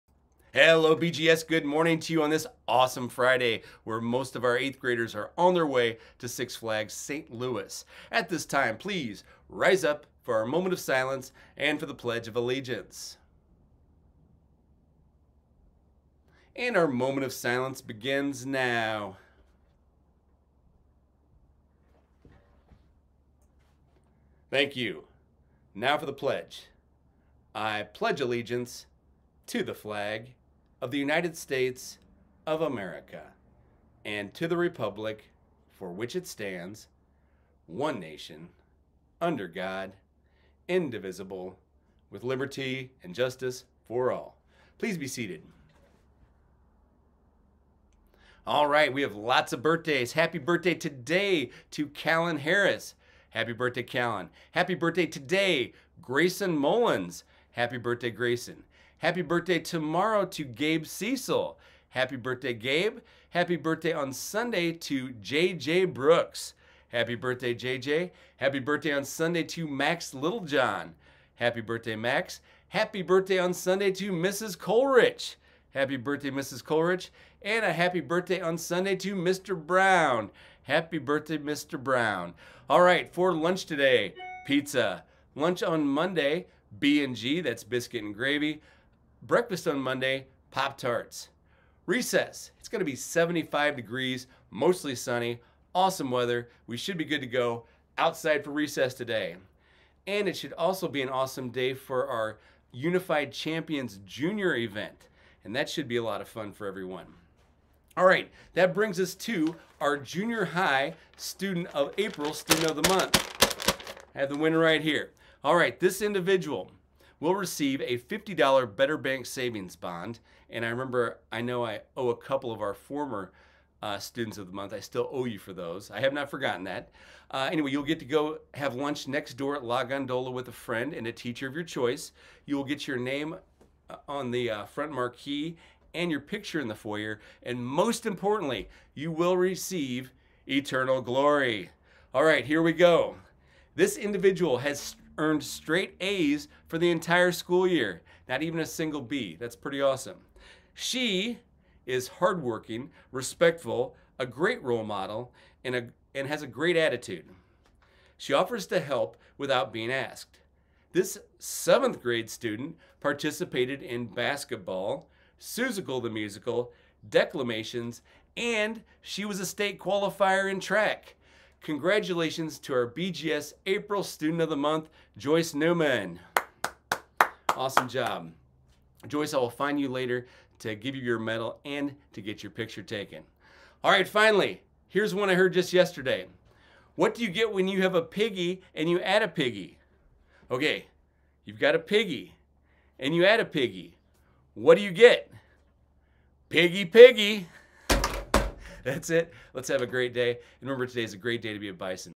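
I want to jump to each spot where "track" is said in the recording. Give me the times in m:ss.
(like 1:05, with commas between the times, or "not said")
2:50.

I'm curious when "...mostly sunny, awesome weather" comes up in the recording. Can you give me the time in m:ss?
1:34.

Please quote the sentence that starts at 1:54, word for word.
I have the winner right here.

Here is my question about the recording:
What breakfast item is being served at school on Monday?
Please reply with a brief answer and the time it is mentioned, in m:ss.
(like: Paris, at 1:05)
Pop Tarts, at 1:30.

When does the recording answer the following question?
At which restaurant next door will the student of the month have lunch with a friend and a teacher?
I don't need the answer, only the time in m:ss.
2:09.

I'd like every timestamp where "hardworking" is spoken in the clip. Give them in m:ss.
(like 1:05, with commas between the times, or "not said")
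2:32.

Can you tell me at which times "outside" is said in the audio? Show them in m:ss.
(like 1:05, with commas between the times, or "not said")
1:37.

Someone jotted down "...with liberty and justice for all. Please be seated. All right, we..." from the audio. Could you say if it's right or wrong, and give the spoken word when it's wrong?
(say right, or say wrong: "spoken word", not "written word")
right.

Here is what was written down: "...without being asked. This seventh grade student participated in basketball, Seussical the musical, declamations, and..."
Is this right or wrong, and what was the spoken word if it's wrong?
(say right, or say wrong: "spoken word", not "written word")
right.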